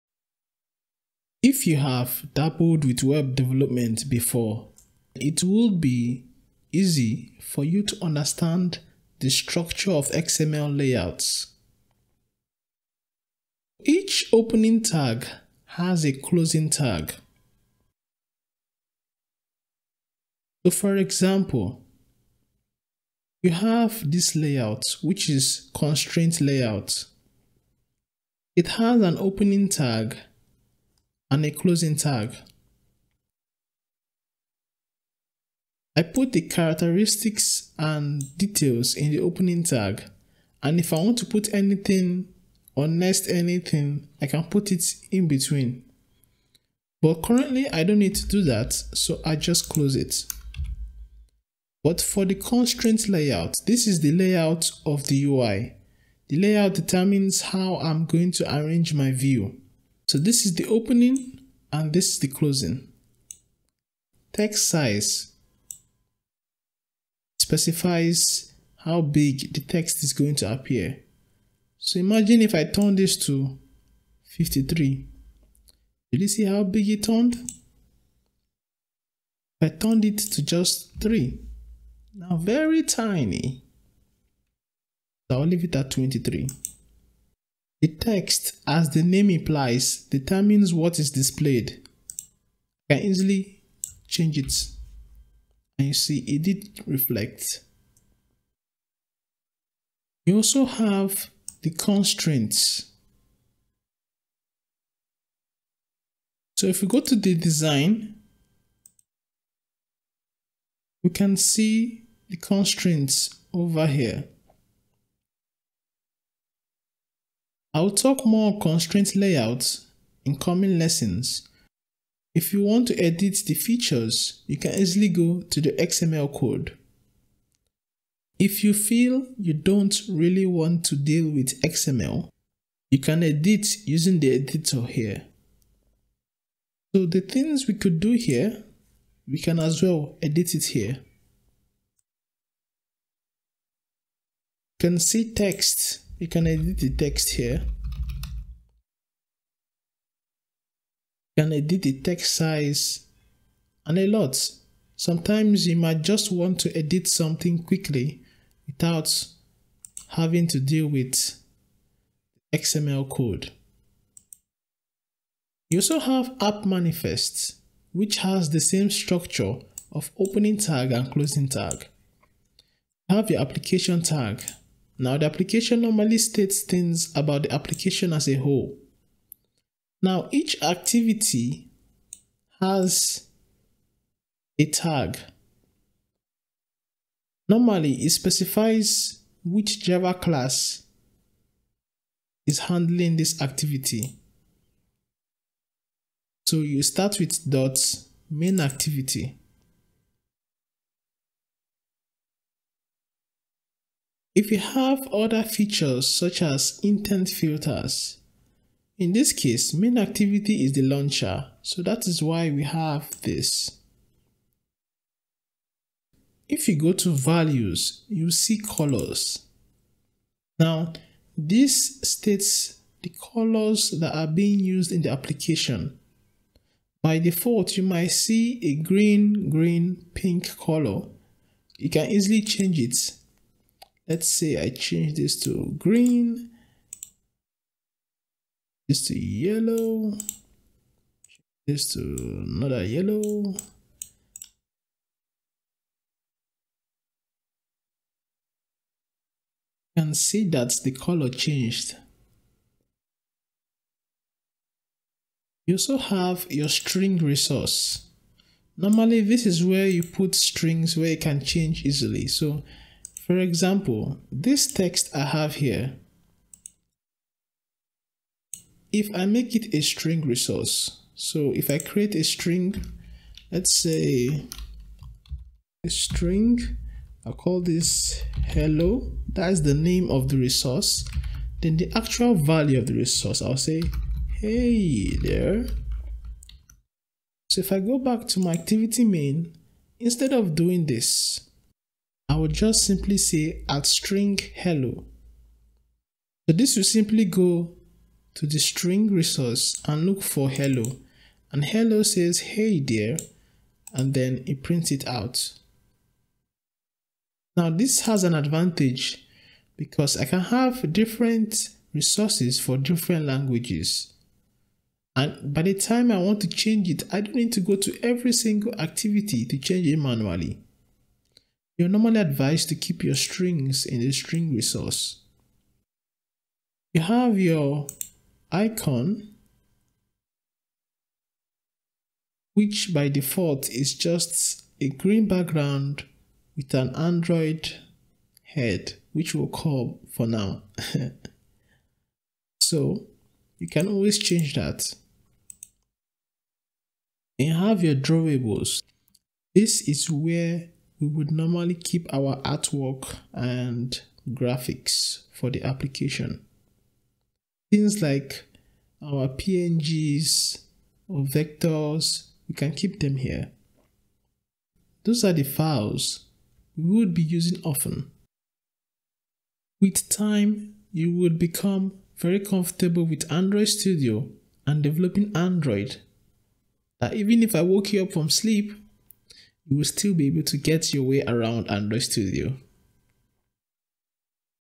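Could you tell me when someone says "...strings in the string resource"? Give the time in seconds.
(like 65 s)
323 s.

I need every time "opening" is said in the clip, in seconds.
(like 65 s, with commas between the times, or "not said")
14 s, 29 s, 39 s, 60 s, 170 s.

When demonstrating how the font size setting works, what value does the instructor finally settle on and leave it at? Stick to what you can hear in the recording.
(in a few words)
23.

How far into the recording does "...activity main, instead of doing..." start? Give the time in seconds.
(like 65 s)
288 s.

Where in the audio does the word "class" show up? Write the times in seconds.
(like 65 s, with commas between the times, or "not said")
190 s.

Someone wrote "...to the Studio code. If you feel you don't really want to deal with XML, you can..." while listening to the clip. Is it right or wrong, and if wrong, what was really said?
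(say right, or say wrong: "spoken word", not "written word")
wrong: "XML", not "Studio".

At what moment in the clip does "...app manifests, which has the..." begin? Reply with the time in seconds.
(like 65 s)
166 s.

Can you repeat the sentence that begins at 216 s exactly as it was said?
If you go to values, you see colors.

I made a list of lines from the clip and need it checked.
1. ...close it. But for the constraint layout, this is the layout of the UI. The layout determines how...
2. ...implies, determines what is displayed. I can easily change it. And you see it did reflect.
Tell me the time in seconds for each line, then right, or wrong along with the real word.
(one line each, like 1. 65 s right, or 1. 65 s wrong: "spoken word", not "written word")
1. 49 s right
2. 89 s right.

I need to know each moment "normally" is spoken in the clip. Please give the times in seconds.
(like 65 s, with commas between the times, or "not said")
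175 s, 187 s, 258 s, 321 s, 351 s.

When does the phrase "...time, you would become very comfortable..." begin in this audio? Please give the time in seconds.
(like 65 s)
370 s.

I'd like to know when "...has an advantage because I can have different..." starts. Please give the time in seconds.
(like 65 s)
308 s.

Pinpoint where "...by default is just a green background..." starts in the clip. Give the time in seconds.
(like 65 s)
332 s.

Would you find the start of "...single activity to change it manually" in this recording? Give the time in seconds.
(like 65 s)
318 s.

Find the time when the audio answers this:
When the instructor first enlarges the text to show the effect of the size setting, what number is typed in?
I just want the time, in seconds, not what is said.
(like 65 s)
74 s.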